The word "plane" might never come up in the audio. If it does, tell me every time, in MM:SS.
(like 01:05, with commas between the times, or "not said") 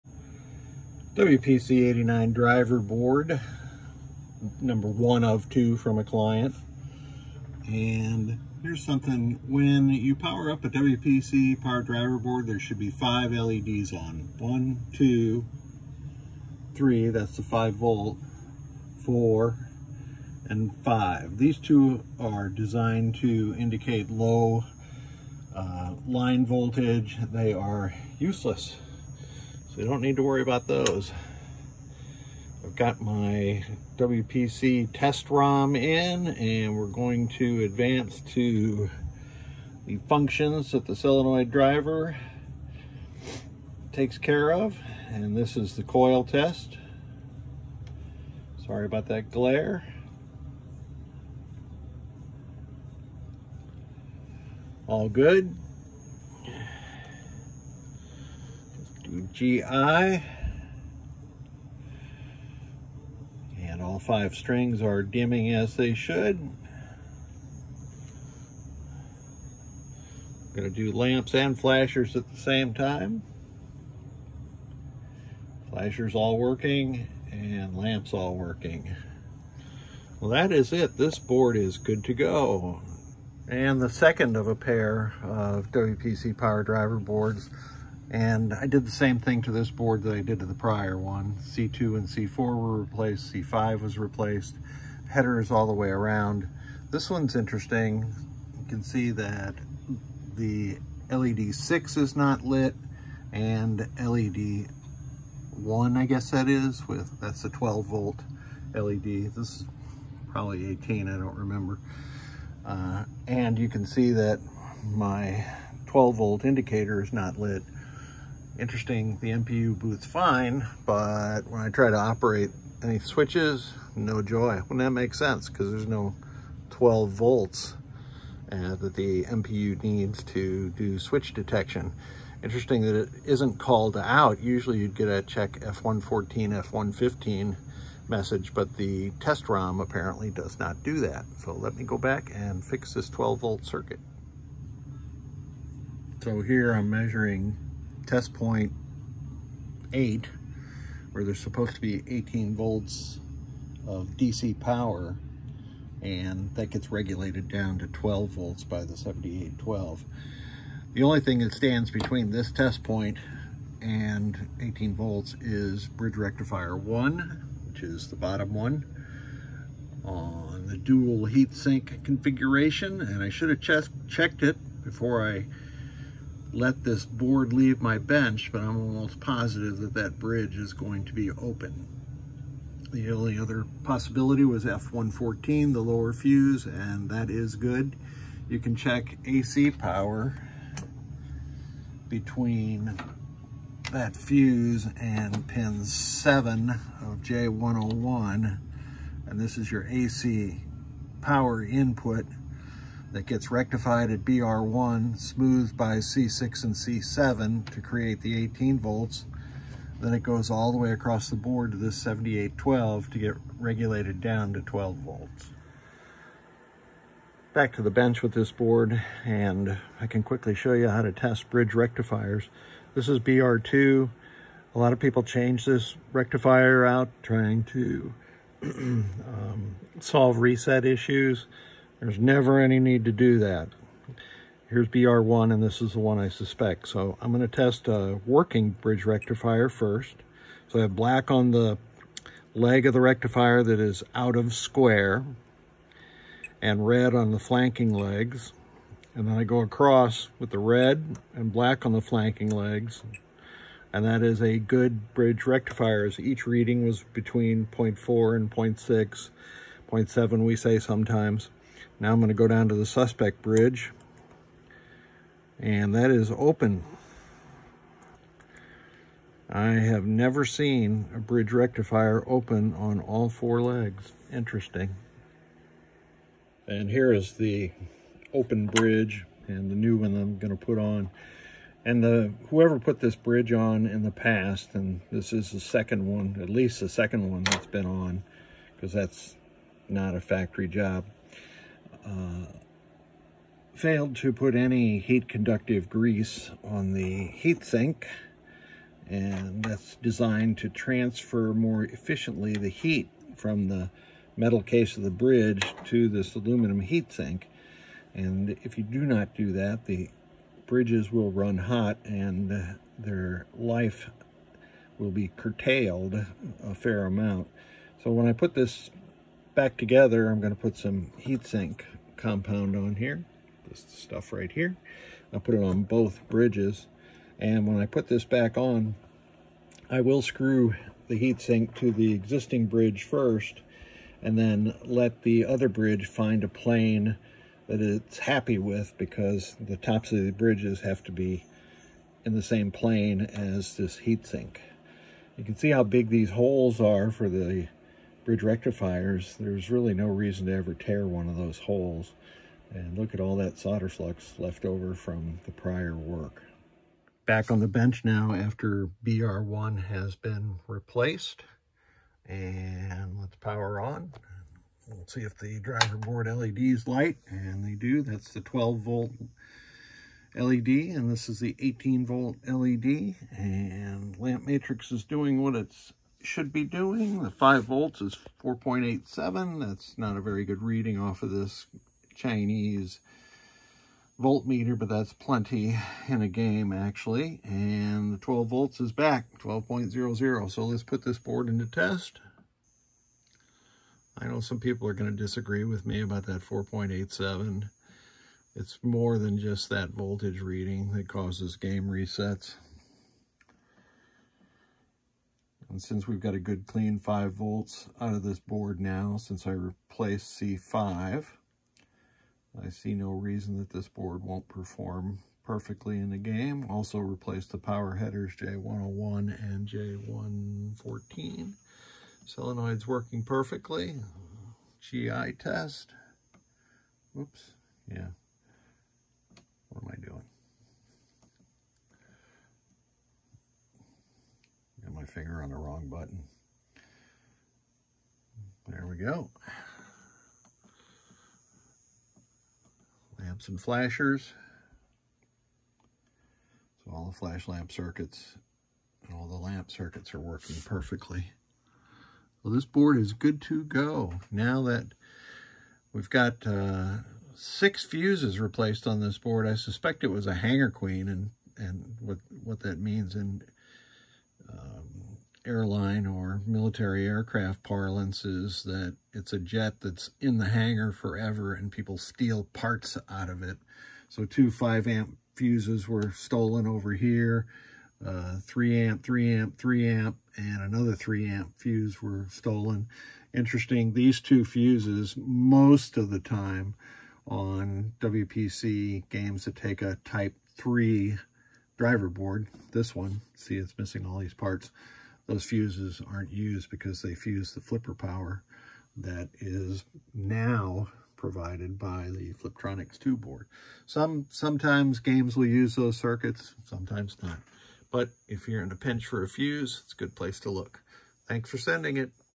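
05:36, 05:42.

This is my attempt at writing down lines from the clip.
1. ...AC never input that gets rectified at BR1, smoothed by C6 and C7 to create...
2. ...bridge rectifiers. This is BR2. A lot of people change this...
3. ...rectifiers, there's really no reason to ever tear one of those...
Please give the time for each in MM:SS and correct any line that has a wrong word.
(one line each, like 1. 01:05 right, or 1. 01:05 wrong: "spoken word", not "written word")
1. 03:19 wrong: "power", not "never"
2. 03:41 right
3. 05:48 right.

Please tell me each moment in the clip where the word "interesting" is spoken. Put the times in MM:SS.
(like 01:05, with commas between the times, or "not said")
01:37, 01:58, 02:12, 04:34, 08:03.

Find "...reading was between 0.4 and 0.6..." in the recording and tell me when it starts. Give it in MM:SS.
04:16.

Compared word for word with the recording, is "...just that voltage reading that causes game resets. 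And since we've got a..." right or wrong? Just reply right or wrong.
right.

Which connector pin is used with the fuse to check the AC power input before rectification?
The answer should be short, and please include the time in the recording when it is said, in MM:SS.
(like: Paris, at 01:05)
Pin 7 of J101, at 03:15.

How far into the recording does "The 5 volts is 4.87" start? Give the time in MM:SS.
06:17.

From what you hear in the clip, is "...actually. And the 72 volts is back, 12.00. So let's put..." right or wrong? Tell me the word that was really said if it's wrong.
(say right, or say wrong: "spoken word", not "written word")
wrong: "12", not "72".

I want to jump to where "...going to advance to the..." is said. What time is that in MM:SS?
00:36.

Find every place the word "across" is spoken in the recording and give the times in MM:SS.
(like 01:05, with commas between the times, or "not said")
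03:30, 04:09.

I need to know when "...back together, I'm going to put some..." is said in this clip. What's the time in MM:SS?
05:19.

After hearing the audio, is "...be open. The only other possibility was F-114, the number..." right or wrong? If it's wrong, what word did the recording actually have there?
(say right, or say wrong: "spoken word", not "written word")
wrong: "lower", not "number".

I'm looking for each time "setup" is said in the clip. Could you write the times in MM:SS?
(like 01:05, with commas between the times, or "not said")
not said.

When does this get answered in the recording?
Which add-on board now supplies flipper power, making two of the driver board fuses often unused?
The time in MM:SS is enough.
08:22.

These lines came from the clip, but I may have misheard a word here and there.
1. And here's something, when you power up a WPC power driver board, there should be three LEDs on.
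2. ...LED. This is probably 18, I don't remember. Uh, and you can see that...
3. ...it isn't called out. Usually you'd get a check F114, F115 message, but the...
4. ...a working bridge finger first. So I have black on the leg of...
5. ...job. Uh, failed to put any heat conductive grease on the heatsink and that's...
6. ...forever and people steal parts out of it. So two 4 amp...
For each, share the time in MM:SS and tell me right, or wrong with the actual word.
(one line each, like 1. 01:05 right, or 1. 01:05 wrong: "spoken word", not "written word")
1. 00:07 wrong: "five", not "three"
2. 01:48 right
3. 02:12 right
4. 03:57 wrong: "rectifier", not "finger"
5. 04:50 right
6. 07:50 wrong: "5", not "4".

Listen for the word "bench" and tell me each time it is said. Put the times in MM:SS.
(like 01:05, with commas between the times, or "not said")
02:57, 03:37, 05:57.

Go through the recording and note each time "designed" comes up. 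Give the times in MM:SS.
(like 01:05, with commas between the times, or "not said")
00:22, 05:00.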